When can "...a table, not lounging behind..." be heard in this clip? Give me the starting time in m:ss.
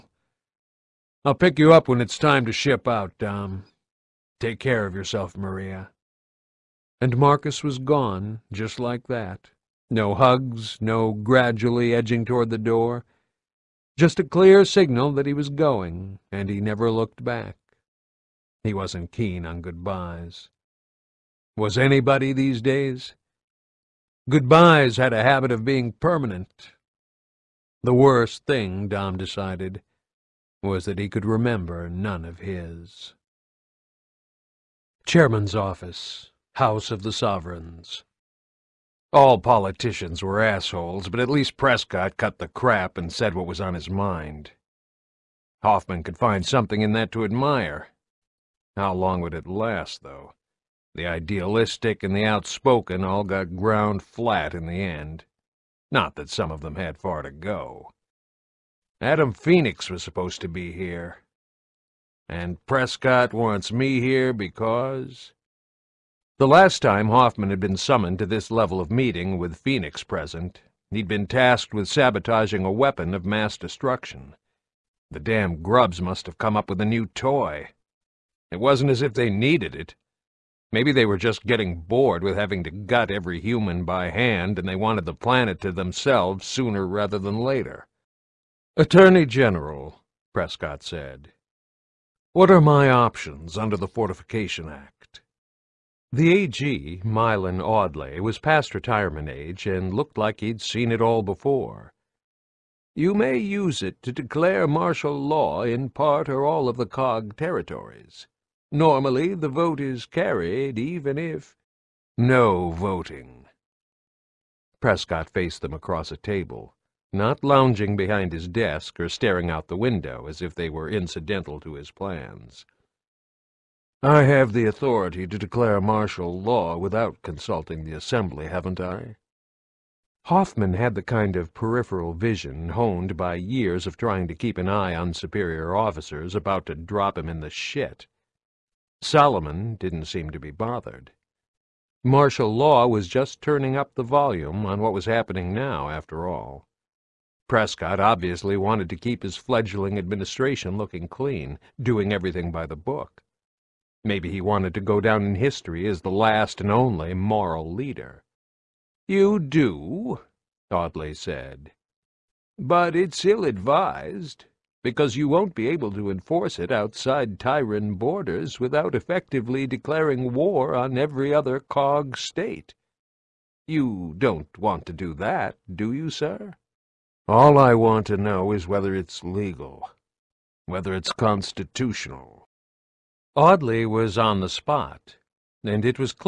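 1:56.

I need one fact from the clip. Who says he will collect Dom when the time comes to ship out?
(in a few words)
Marcus.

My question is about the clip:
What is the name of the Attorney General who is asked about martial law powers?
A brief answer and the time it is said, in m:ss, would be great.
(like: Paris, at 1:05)
Mylan Audley, at 1:37.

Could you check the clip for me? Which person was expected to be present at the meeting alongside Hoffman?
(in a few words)
Adam Phoenix.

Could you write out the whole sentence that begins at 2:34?
Maybe he wanted to go down in history as the last and only moral leader.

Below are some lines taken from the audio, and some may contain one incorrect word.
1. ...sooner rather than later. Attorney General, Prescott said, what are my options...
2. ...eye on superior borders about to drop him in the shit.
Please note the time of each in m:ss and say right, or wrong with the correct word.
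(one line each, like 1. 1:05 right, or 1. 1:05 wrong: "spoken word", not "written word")
1. 1:26 right
2. 2:14 wrong: "officers", not "borders".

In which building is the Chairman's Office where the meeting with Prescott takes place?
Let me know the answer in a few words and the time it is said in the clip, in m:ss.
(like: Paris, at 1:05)
House of the Sovereigns, at 0:36.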